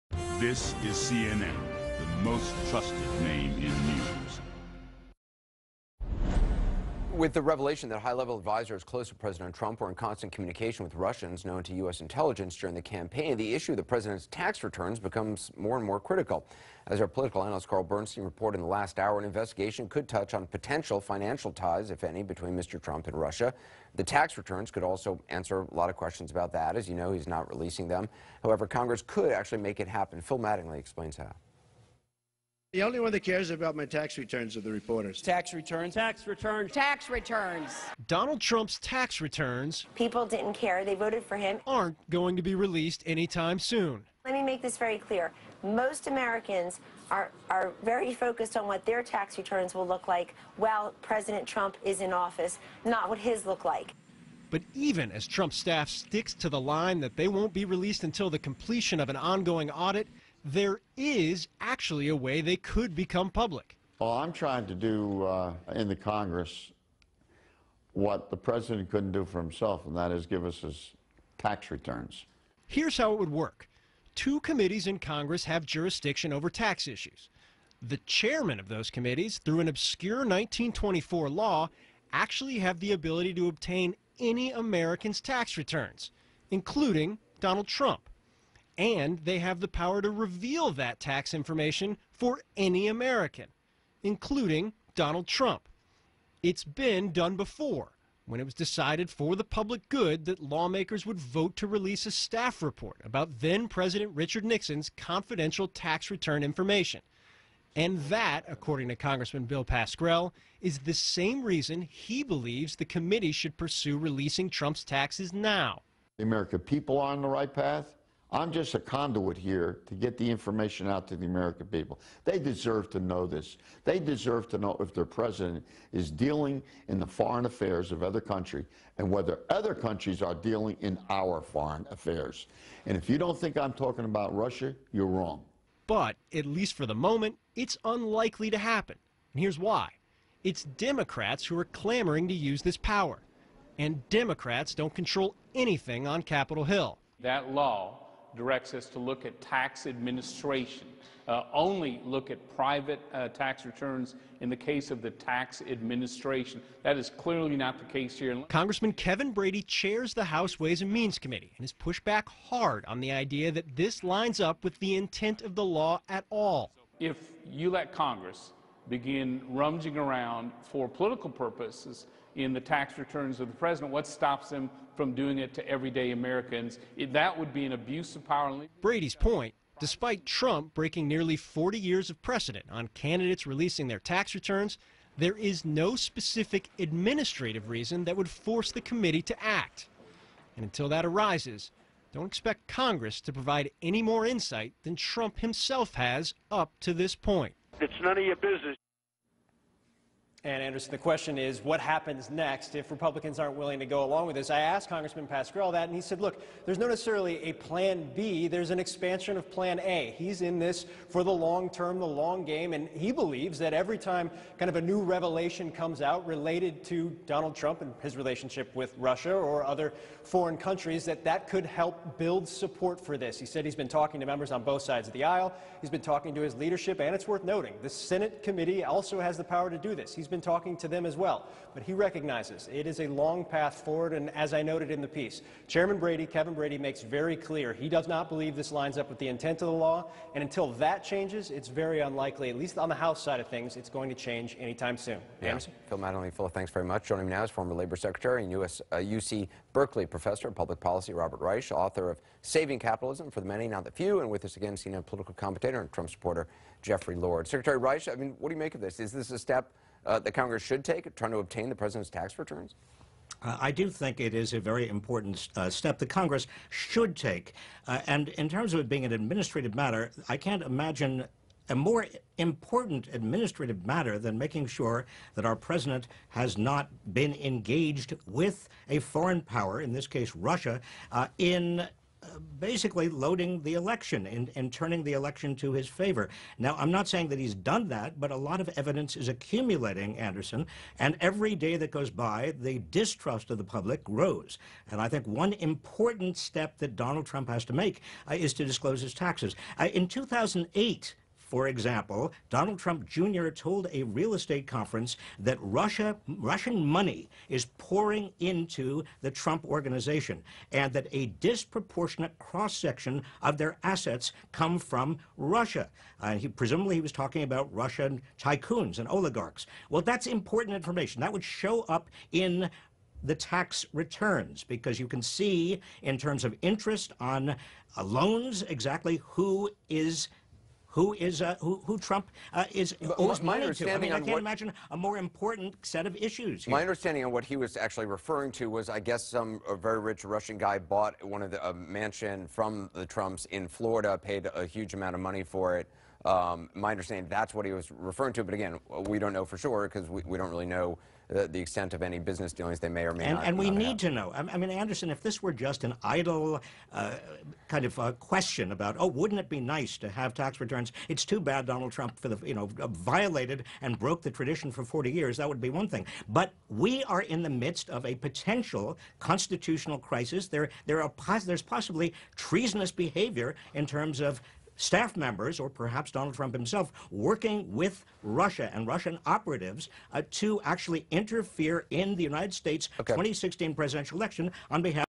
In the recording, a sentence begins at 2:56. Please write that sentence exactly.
It, that would be an abuse of power.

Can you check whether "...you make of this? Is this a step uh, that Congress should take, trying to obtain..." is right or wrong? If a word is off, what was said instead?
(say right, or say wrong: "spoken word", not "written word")
right.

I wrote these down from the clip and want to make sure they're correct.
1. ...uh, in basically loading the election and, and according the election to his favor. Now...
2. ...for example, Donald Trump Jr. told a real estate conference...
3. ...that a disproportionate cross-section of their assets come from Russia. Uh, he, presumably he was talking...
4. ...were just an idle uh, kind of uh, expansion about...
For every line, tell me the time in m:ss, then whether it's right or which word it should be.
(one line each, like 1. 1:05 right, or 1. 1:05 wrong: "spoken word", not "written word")
1. 4:41 wrong: "turning", not "according"
2. 5:01 right
3. 5:10 right
4. 5:55 wrong: "question", not "expansion".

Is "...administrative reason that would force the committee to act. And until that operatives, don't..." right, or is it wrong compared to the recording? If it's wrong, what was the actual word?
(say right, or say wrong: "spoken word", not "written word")
wrong: "arises", not "operatives".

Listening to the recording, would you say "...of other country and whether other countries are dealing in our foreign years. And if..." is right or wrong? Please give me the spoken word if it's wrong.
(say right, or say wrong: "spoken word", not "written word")
wrong: "affairs", not "years".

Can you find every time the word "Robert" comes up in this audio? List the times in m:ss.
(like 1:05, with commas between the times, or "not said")
4:11.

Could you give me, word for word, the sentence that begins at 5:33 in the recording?
I mean, I can't imagine a more important set of issues.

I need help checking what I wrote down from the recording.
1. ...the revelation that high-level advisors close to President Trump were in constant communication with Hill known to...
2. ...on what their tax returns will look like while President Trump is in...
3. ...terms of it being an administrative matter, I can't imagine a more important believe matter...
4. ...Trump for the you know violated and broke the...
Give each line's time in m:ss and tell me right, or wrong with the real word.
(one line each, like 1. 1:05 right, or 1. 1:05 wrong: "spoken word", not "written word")
1. 0:07 wrong: "Russians", not "Hill"
2. 0:48 right
3. 4:28 wrong: "administrative", not "believe"
4. 6:01 right.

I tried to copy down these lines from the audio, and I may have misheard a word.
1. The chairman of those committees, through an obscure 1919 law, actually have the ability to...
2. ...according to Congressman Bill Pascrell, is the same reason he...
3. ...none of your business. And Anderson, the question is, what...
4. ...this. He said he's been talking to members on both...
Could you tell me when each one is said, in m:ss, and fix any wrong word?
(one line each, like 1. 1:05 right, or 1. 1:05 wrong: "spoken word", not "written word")
1. 1:17 wrong: "1924", not "1919"
2. 1:48 right
3. 3:18 right
4. 3:43 right.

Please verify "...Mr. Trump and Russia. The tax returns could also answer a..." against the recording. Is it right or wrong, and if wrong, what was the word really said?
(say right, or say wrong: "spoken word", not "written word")
right.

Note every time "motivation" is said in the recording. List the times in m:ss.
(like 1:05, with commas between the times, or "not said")
not said.